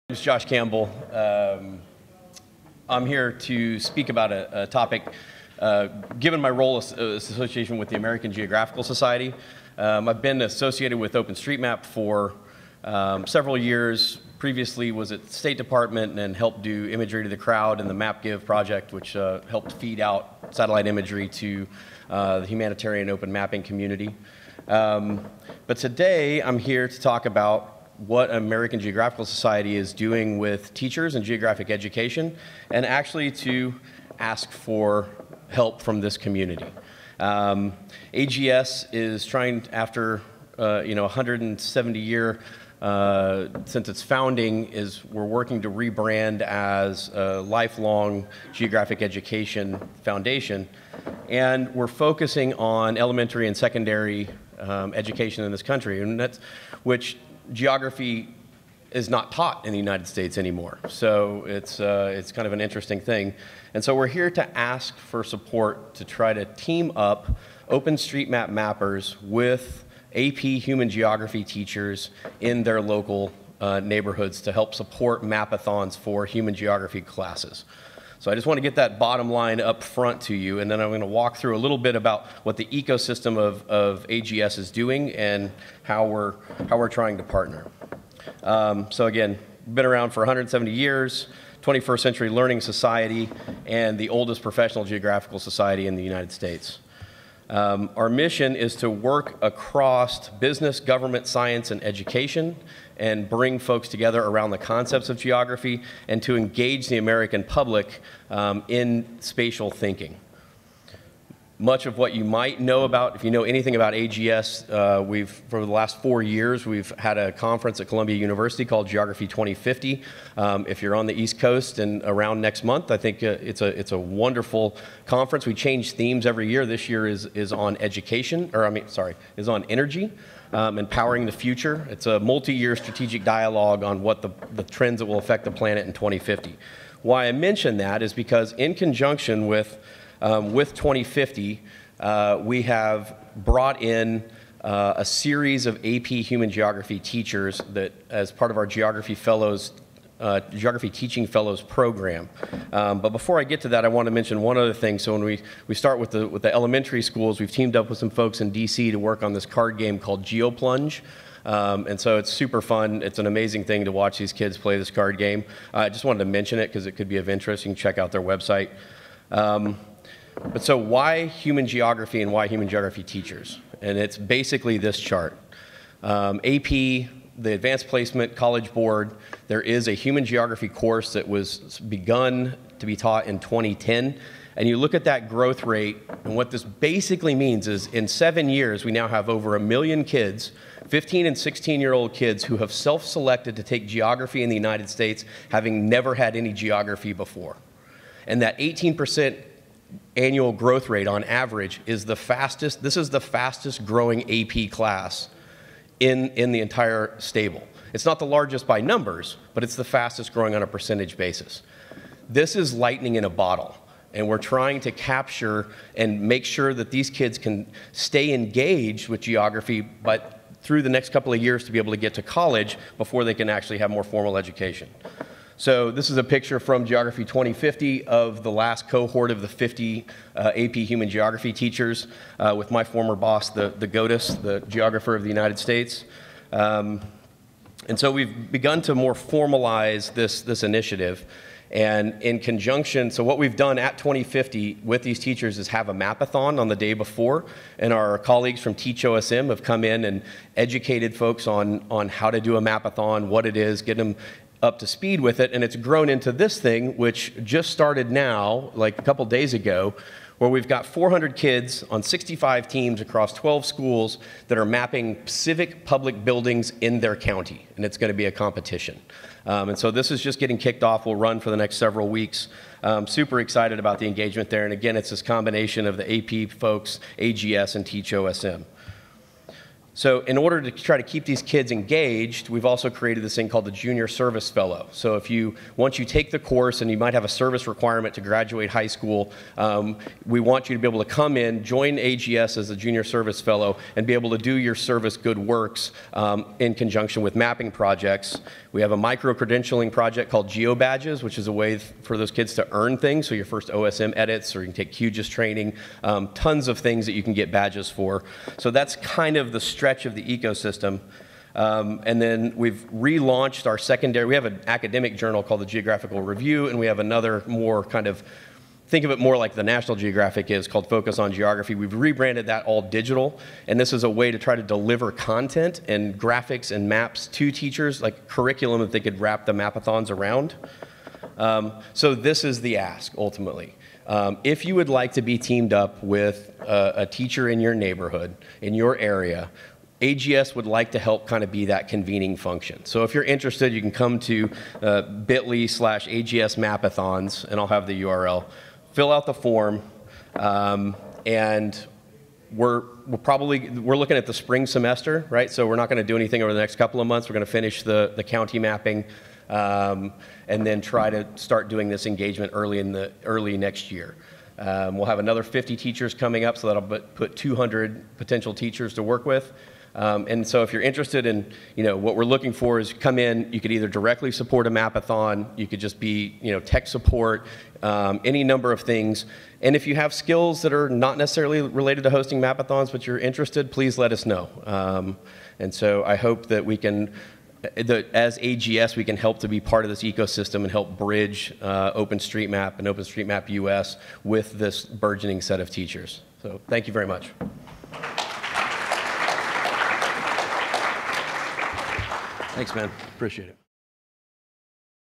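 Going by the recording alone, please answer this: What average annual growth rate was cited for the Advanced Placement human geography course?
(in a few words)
18%.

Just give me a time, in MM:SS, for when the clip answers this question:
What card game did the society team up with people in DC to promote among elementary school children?
02:40.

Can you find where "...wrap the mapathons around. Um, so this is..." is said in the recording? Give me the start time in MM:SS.
05:29.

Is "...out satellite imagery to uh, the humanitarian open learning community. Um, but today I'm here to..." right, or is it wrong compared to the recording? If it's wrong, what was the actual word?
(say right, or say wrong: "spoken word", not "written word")
wrong: "mapping", not "learning".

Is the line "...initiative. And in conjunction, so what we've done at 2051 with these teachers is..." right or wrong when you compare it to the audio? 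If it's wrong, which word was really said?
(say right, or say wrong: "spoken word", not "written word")
wrong: "2050", not "2051".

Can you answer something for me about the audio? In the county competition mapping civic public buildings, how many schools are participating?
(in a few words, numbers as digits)
12.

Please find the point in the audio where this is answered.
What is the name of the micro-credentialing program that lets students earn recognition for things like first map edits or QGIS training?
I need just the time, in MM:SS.
05:00.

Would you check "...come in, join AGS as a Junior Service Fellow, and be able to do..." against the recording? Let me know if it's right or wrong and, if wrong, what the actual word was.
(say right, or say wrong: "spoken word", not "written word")
right.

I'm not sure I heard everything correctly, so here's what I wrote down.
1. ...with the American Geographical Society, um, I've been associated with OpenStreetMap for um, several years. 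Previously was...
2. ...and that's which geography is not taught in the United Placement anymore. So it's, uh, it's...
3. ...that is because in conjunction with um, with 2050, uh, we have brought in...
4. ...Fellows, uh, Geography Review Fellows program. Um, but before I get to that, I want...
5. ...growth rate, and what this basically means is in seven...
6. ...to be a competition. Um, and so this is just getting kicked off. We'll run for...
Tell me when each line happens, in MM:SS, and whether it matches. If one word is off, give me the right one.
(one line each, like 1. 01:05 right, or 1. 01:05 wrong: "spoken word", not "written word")
1. 00:07 right
2. 00:56 wrong: "States", not "Placement"
3. 02:17 right
4. 02:29 wrong: "Teaching", not "Review"
5. 03:05 right
6. 04:28 right.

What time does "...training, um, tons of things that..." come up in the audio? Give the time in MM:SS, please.
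05:05.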